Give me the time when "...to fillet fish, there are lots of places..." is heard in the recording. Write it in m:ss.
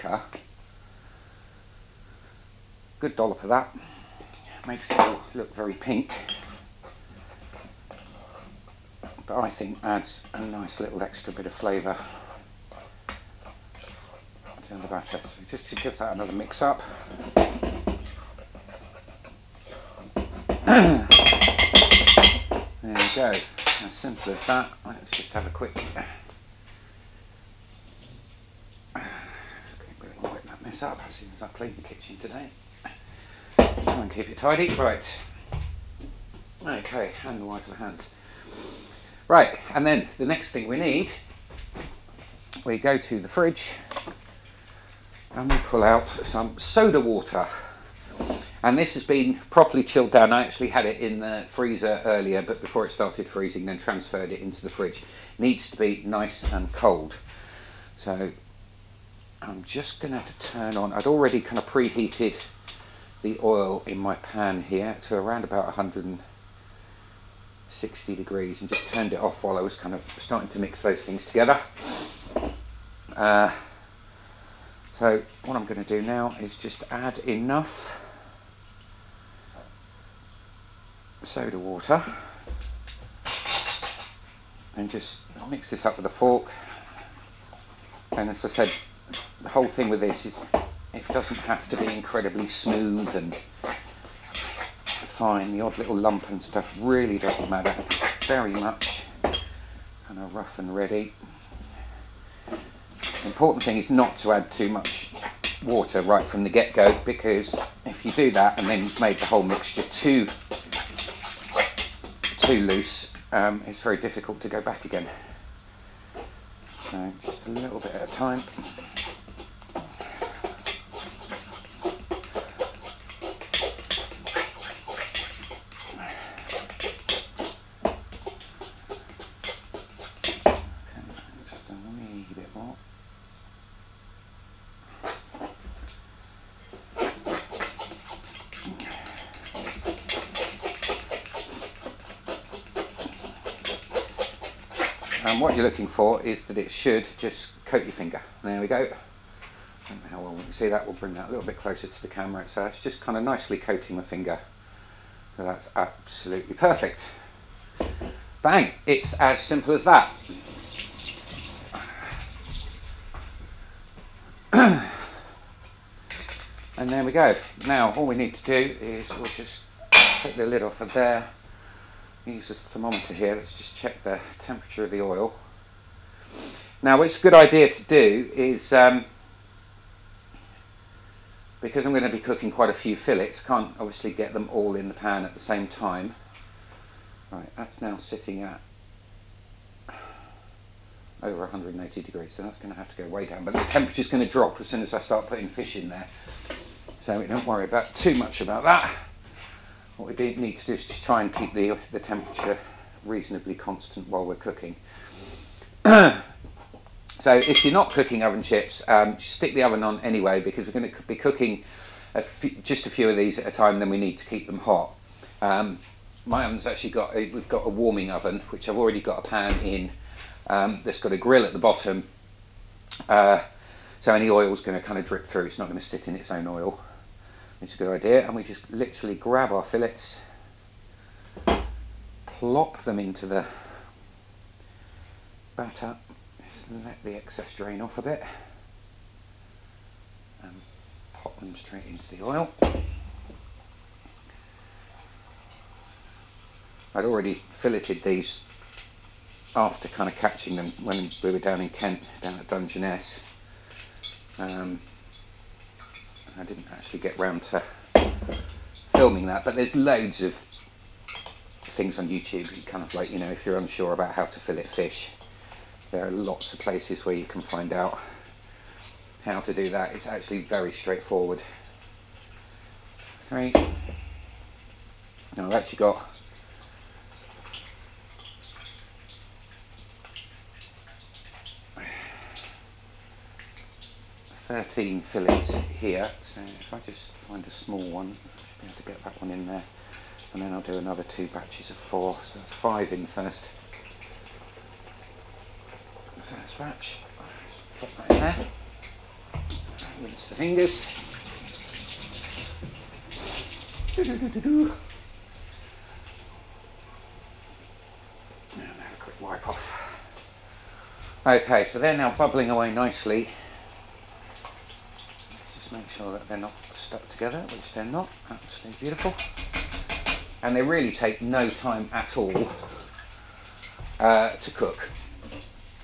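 4:24.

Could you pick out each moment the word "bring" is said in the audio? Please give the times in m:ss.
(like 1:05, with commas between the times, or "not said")
2:30.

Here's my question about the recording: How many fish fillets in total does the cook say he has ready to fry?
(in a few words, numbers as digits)
13.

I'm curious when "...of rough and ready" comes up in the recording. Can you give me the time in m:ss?
1:40.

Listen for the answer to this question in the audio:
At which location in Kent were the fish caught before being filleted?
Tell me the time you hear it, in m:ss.
4:12.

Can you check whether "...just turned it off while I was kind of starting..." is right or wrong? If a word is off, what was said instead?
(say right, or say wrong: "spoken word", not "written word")
right.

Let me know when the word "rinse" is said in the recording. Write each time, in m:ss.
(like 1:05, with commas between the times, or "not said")
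5:00.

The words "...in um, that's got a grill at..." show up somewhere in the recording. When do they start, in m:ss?
3:39.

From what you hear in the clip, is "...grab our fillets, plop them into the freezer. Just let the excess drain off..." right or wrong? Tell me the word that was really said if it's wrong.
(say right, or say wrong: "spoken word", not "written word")
wrong: "batter", not "freezer".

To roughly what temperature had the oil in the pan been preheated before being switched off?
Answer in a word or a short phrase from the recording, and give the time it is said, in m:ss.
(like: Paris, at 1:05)
160 degrees, at 1:05.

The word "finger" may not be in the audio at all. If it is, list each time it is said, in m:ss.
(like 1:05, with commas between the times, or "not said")
2:27, 2:34, 5:00.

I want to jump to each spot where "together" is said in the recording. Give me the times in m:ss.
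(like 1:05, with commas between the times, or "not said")
1:11, 5:17.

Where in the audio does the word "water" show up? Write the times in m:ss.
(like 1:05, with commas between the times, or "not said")
0:46, 1:21, 1:45.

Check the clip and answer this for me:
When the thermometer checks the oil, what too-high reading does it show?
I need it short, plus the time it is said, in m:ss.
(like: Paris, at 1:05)
Over 180 degrees, at 3:11.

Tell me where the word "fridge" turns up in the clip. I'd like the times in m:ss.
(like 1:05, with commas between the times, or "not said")
0:43, 0:54.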